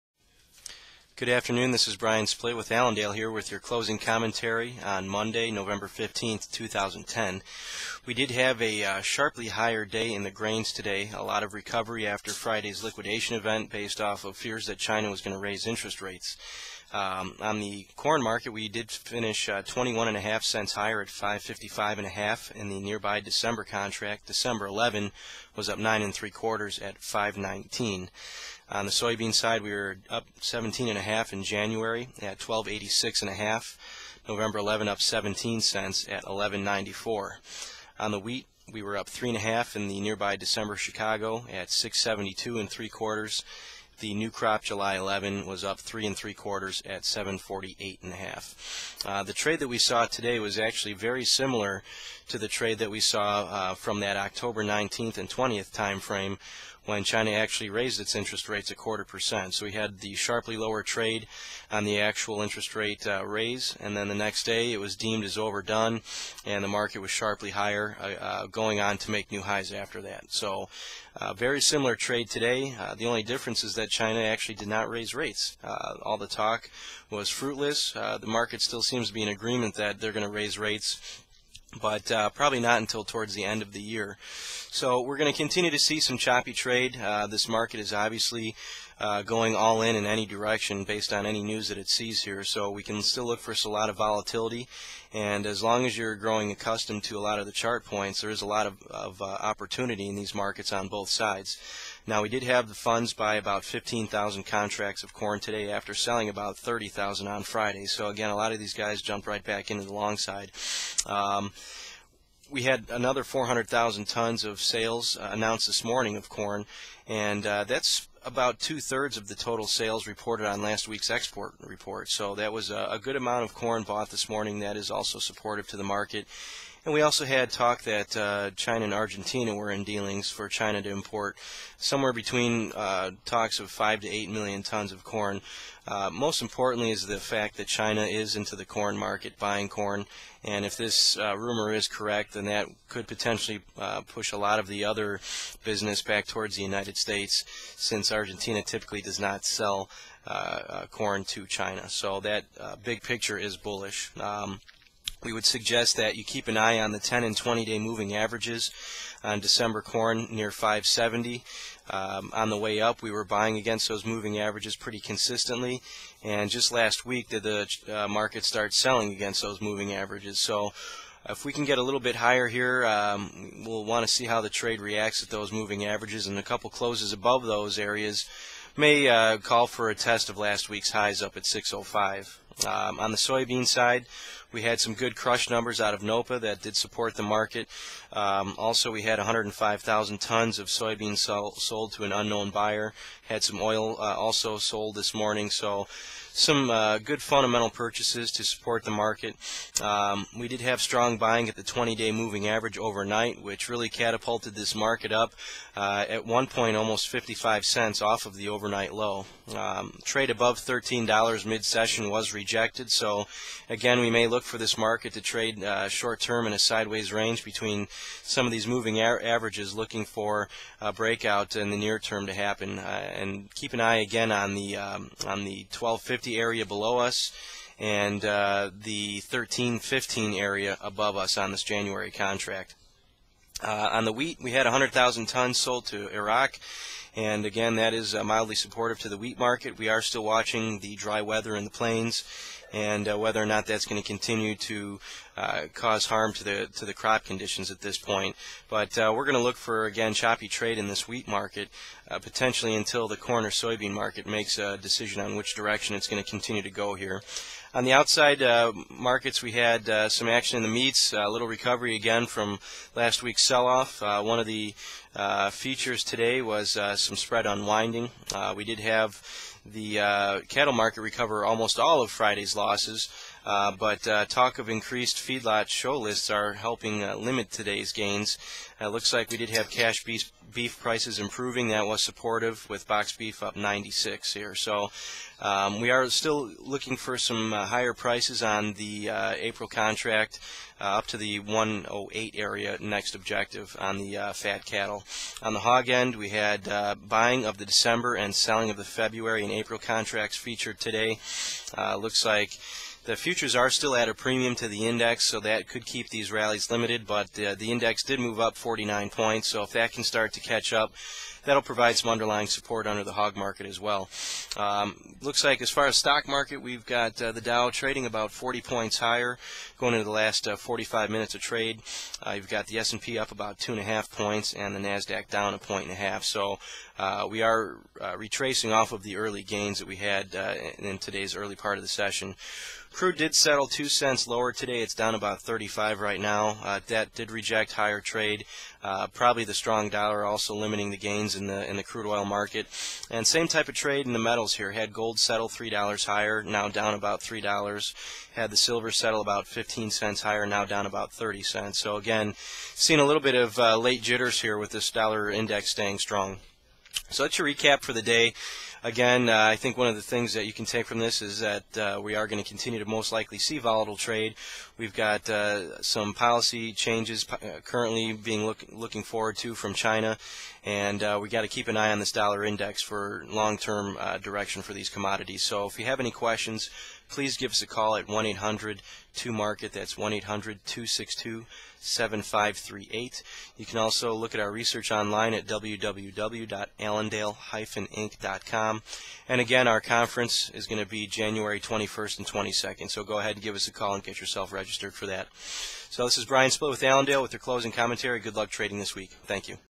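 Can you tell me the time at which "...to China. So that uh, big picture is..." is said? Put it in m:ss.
2:31.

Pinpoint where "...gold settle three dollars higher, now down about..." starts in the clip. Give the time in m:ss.
5:44.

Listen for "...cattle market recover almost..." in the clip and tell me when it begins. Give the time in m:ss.
4:30.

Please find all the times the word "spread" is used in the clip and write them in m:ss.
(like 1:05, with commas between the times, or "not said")
4:27.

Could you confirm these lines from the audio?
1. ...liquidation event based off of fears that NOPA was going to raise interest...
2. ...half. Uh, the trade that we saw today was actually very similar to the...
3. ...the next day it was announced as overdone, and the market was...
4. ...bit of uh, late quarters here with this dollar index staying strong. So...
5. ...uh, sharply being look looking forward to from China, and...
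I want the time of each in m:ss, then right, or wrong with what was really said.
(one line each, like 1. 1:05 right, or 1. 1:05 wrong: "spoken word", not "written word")
1. 0:12 wrong: "China", not "NOPA"
2. 0:48 right
3. 1:04 wrong: "deemed", not "announced"
4. 5:53 wrong: "jitters", not "quarters"
5. 6:07 wrong: "currently", not "sharply".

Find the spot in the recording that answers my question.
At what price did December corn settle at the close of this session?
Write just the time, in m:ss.
0:21.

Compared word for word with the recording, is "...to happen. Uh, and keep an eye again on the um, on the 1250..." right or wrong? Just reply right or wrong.
right.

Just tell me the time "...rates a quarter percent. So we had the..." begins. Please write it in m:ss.
0:58.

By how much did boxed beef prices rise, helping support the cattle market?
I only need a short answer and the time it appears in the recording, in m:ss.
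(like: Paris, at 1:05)
96, at 4:43.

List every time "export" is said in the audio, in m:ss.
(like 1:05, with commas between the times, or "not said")
2:01.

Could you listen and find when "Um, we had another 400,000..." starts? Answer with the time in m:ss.
1:51.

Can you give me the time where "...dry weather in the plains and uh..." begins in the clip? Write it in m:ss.
4:00.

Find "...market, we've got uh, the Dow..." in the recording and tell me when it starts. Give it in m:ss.
5:16.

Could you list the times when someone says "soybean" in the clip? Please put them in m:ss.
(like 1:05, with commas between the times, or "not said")
0:28, 3:03, 3:10, 4:13.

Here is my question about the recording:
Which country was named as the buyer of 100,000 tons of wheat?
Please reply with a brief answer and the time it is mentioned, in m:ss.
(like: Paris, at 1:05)
Iraq, at 3:56.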